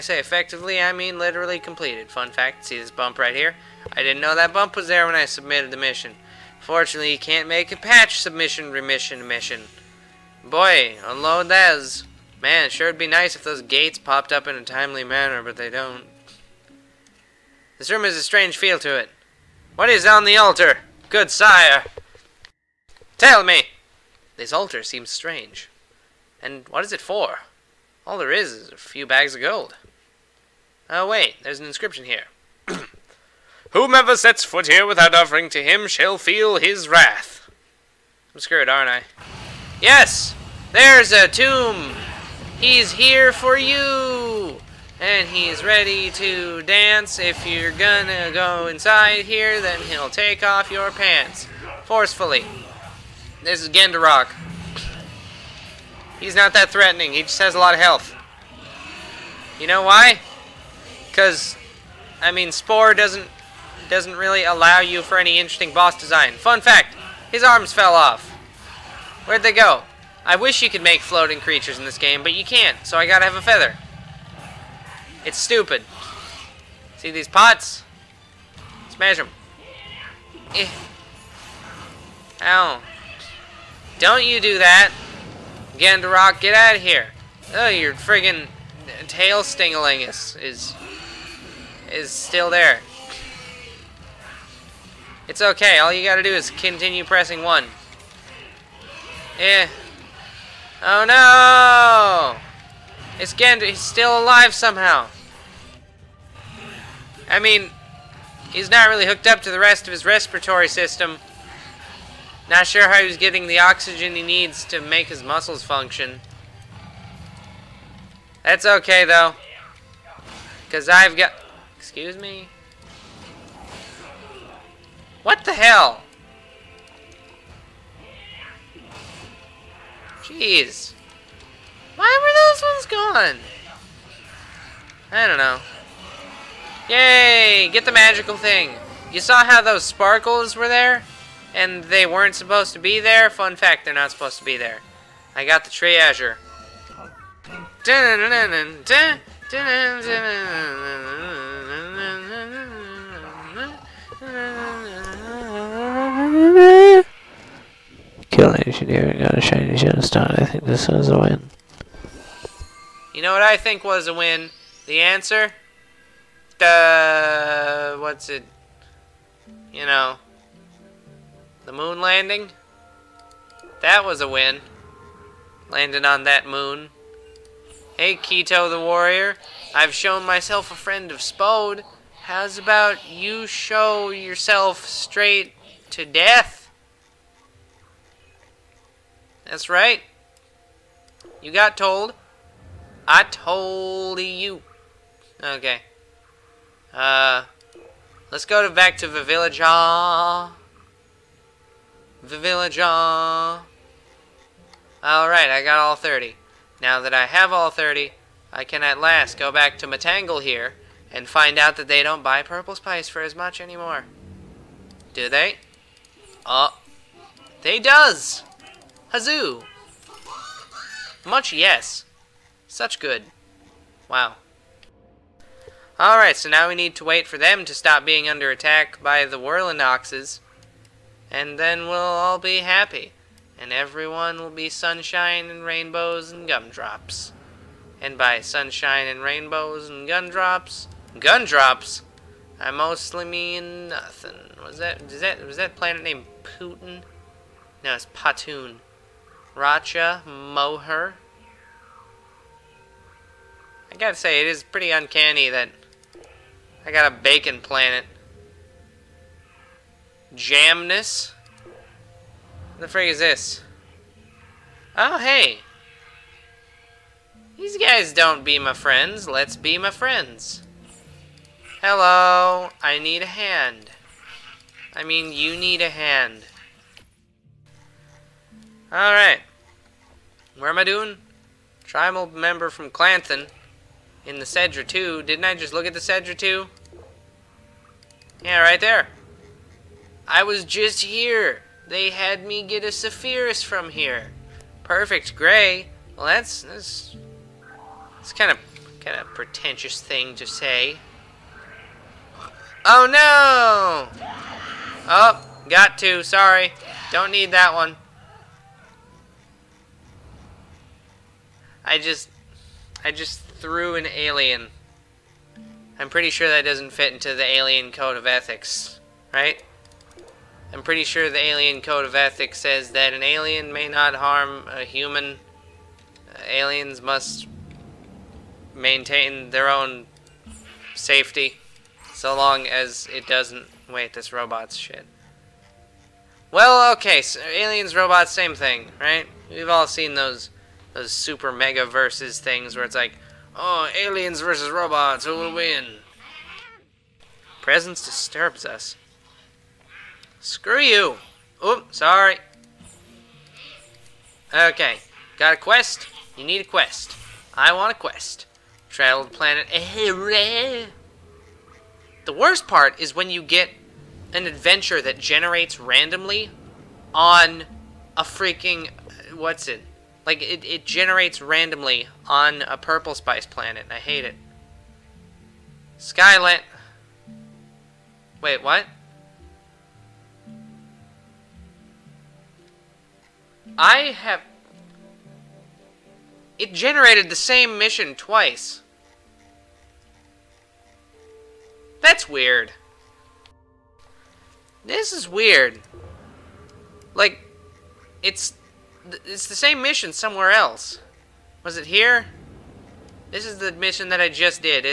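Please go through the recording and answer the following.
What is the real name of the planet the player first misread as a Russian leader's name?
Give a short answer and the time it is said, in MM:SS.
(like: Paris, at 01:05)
Patoon, at 04:08.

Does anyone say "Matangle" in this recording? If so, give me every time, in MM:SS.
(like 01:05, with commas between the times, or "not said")
03:29.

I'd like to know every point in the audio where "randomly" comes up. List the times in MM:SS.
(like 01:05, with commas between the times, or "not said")
06:05, 06:11.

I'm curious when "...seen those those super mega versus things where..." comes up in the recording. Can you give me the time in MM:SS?
05:39.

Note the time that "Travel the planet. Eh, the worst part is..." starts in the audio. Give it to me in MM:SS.
05:58.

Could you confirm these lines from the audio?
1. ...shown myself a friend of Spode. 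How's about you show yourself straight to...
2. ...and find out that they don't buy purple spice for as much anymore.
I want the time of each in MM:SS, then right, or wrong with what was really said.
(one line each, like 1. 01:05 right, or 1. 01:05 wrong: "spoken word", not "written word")
1. 02:59 right
2. 03:31 right.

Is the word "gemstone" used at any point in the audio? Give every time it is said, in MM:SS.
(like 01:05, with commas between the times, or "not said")
02:39.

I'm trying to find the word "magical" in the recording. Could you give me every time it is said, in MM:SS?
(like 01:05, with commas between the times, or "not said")
02:17.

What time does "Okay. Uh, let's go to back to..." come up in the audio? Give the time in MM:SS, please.
03:15.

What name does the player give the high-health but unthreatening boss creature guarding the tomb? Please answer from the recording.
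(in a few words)
Gendarock.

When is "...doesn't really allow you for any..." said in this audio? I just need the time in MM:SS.
01:03.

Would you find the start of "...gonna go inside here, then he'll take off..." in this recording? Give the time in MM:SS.
00:47.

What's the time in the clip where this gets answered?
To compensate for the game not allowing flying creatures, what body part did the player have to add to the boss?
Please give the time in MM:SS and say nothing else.
01:13.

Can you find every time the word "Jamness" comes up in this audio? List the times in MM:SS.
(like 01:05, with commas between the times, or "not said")
04:20.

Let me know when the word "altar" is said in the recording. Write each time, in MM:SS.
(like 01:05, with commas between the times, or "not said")
00:20, 00:24.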